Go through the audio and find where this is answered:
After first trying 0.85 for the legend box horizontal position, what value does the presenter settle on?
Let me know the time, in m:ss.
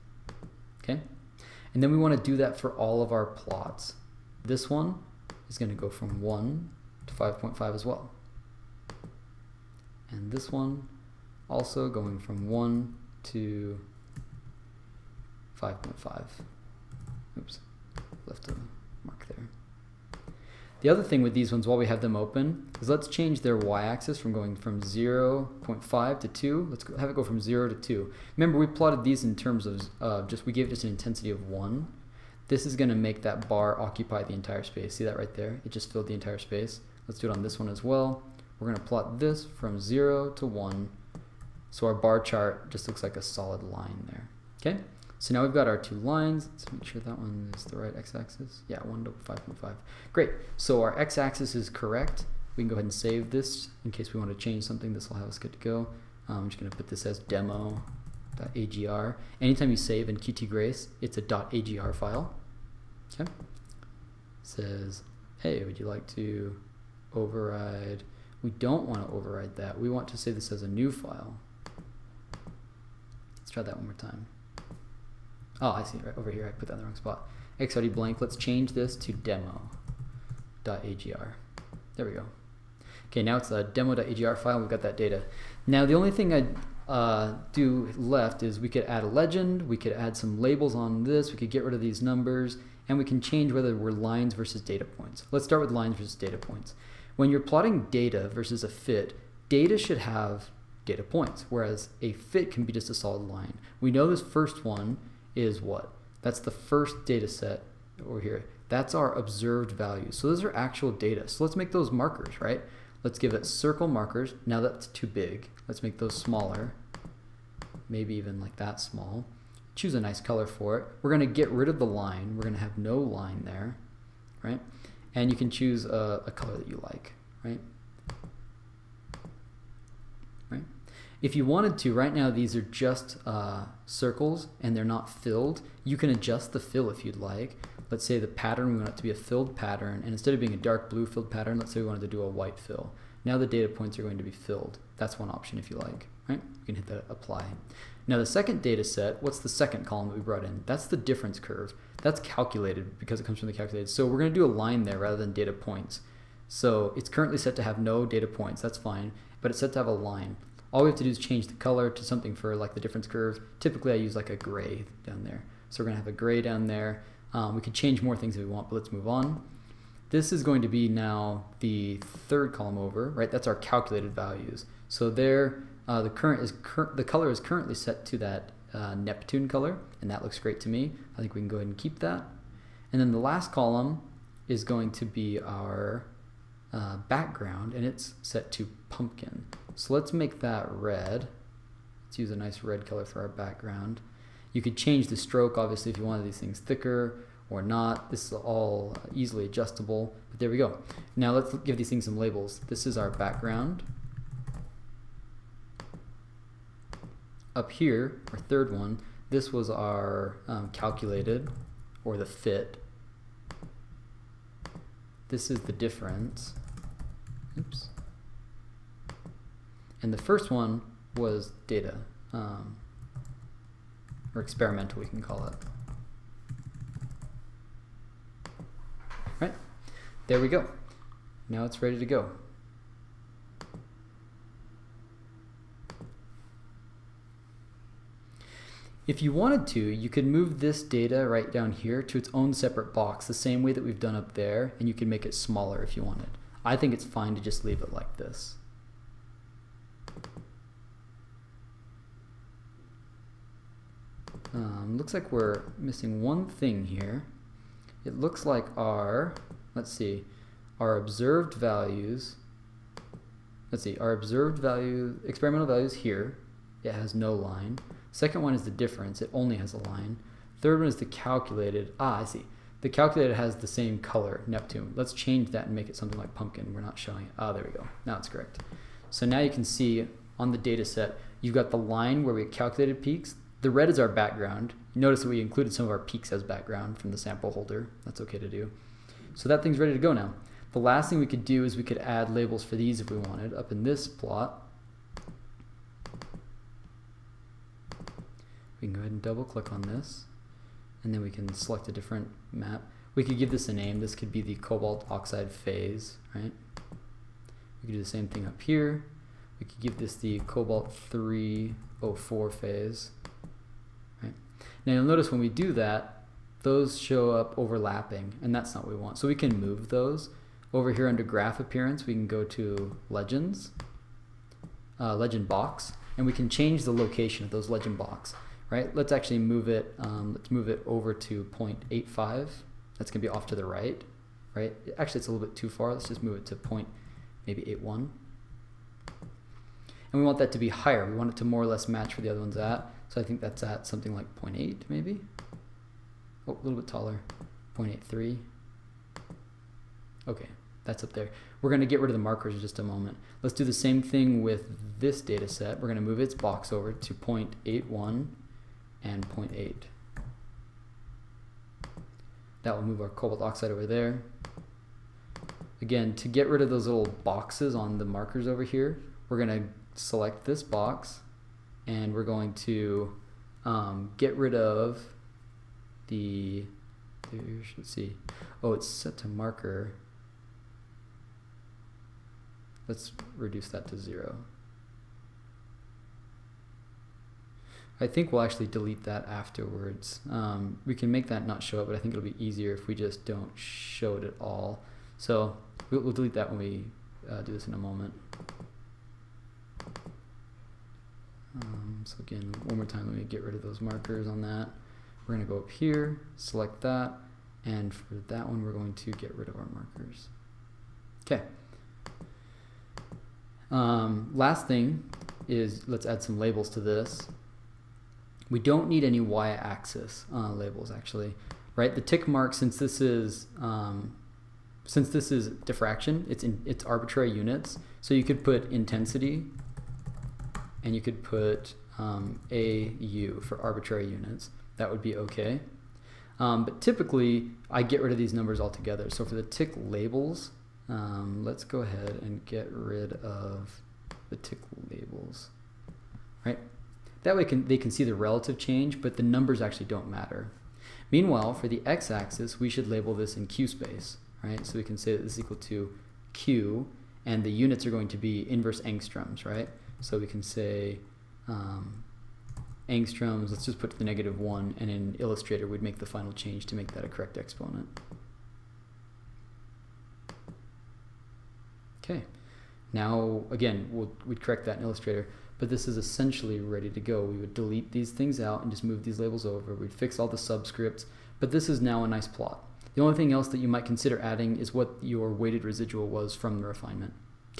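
5:36.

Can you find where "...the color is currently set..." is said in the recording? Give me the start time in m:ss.
2:56.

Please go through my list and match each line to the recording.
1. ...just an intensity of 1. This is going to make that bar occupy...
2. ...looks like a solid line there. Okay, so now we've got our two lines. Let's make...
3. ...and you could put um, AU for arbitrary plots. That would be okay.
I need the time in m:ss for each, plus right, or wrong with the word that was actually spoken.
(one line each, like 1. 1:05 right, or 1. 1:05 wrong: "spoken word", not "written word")
1. 0:30 right
2. 0:42 right
3. 7:10 wrong: "units", not "plots".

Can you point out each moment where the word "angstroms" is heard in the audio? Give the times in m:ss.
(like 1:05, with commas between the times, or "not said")
7:38, 7:42.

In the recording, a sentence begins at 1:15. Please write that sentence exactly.
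Oh, I see, right over here, I put that in the wrong spot.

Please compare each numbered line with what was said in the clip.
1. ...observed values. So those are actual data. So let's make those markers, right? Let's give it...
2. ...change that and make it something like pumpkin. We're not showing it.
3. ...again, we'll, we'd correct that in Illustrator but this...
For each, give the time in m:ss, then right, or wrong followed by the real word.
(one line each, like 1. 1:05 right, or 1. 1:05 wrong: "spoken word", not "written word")
1. 1:49 right
2. 4:35 right
3. 7:53 right.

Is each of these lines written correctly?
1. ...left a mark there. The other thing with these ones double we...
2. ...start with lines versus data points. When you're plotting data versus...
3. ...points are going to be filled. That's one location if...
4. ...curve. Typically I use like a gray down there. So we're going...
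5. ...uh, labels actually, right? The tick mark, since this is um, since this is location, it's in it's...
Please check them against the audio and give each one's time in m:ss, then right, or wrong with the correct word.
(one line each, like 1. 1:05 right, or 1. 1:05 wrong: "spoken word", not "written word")
1. 0:18 wrong: "while", not "double"
2. 1:35 right
3. 2:23 wrong: "option", not "location"
4. 2:43 right
5. 7:00 wrong: "diffraction", not "location".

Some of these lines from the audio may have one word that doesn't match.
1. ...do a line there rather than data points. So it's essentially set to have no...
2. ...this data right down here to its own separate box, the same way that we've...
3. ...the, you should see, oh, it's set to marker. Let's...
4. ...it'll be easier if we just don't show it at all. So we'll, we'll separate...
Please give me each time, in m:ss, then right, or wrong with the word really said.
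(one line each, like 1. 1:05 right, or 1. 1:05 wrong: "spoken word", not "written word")
1. 2:34 wrong: "currently", not "essentially"
2. 4:00 right
3. 6:16 right
4. 6:32 wrong: "delete", not "separate".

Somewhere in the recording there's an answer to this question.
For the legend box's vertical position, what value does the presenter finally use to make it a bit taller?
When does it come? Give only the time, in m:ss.
5:47.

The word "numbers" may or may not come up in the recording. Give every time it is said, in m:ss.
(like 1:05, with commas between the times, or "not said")
1:32, 7:18, 7:29.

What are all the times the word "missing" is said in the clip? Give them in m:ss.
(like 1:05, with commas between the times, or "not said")
4:15.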